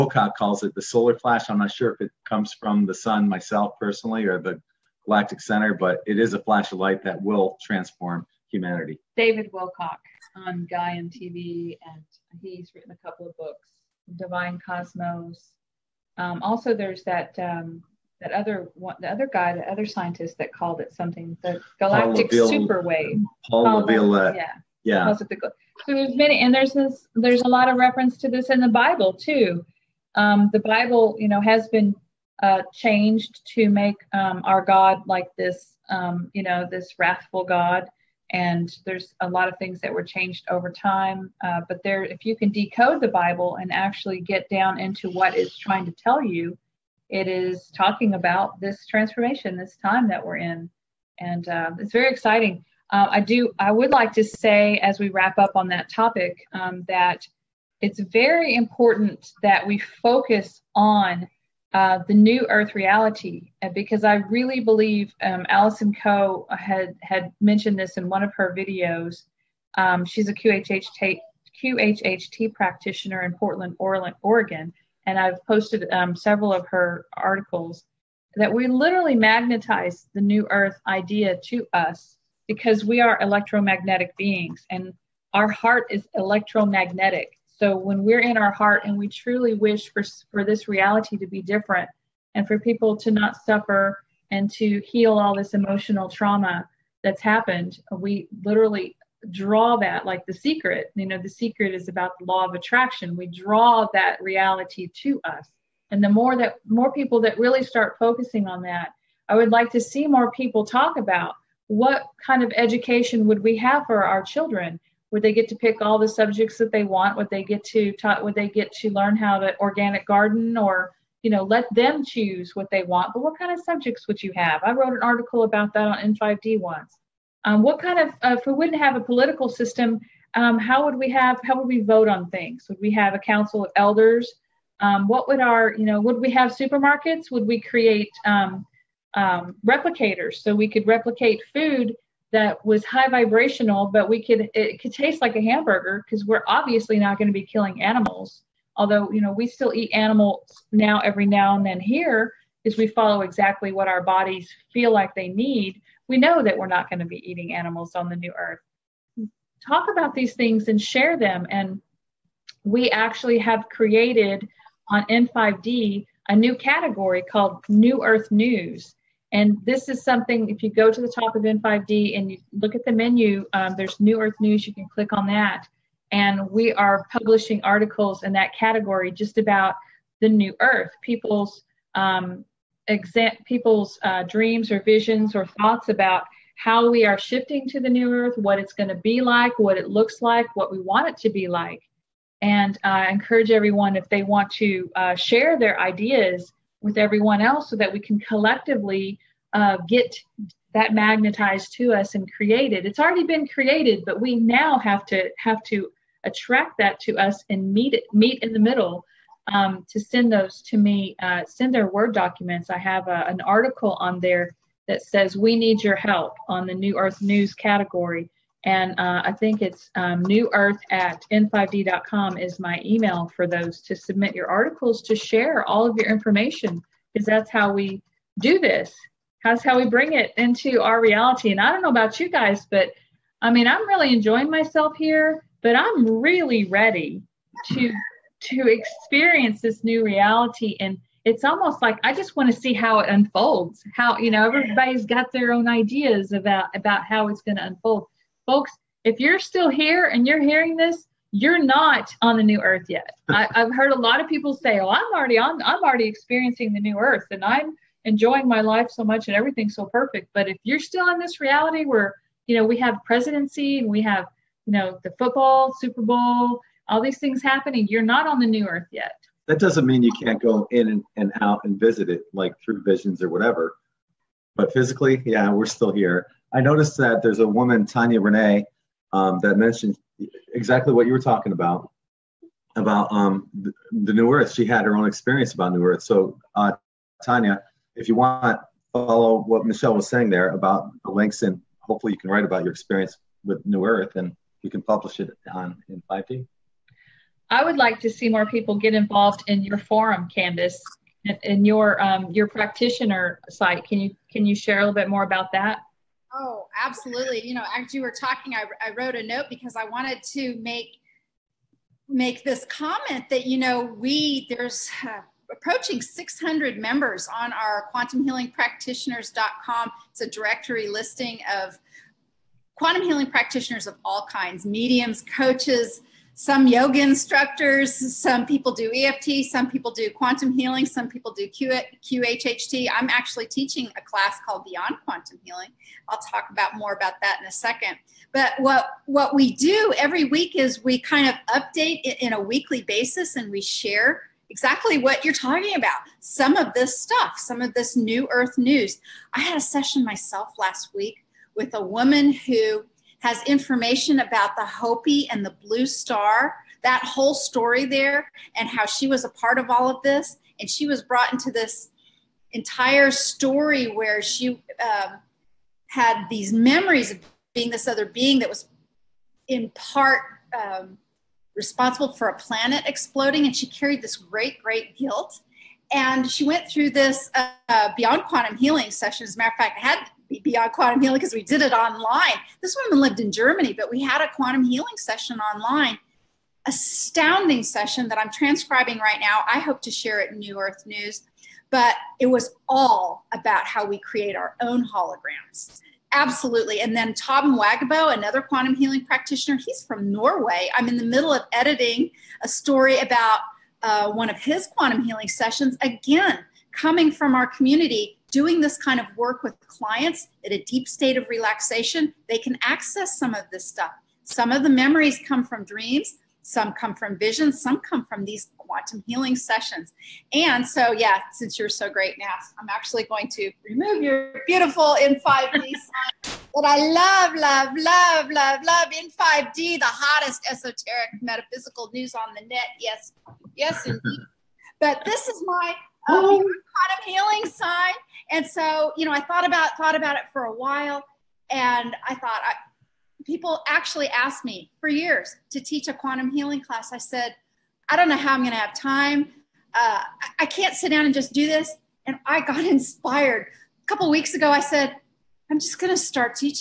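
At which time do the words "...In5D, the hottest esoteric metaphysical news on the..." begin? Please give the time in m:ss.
7:08.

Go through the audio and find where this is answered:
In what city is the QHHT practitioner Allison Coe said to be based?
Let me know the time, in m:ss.
1:13.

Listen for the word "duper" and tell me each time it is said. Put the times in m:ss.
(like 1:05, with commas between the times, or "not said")
not said.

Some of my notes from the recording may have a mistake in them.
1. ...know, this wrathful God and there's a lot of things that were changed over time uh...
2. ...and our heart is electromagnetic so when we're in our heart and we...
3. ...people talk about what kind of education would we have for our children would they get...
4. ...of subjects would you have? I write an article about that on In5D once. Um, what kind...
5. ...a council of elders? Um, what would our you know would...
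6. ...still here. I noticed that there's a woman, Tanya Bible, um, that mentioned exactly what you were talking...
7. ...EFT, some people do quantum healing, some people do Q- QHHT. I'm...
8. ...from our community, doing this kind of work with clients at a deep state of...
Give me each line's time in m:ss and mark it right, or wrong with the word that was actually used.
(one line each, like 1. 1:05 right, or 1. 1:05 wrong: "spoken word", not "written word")
1. 0:36 right
2. 1:24 right
3. 1:50 right
4. 2:03 wrong: "wrote", not "write"
5. 2:13 right
6. 4:35 wrong: "Renee", not "Bible"
7. 5:28 right
8. 6:47 right.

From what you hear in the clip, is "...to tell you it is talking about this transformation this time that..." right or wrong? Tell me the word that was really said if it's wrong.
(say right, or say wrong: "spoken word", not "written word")
right.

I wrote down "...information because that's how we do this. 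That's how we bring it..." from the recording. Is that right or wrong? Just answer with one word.
right.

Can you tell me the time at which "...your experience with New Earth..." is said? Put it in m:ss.
4:52.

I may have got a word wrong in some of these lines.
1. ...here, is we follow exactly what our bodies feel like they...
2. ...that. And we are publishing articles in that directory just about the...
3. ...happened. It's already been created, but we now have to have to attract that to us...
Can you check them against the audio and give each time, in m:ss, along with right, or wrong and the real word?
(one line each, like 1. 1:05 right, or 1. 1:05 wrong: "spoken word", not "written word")
1. 2:31 right
2. 2:55 wrong: "category", not "directory"
3. 3:22 wrong: "created", not "happened".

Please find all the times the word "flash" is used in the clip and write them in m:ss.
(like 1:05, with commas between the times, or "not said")
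0:01, 0:06.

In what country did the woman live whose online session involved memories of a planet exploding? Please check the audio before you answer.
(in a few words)
Germany.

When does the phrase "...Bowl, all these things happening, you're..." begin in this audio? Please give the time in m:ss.
4:26.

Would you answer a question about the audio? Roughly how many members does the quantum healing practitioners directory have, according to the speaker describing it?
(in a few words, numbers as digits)
600.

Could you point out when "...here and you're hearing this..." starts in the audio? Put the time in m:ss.
4:09.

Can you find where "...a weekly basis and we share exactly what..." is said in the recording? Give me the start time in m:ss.
5:42.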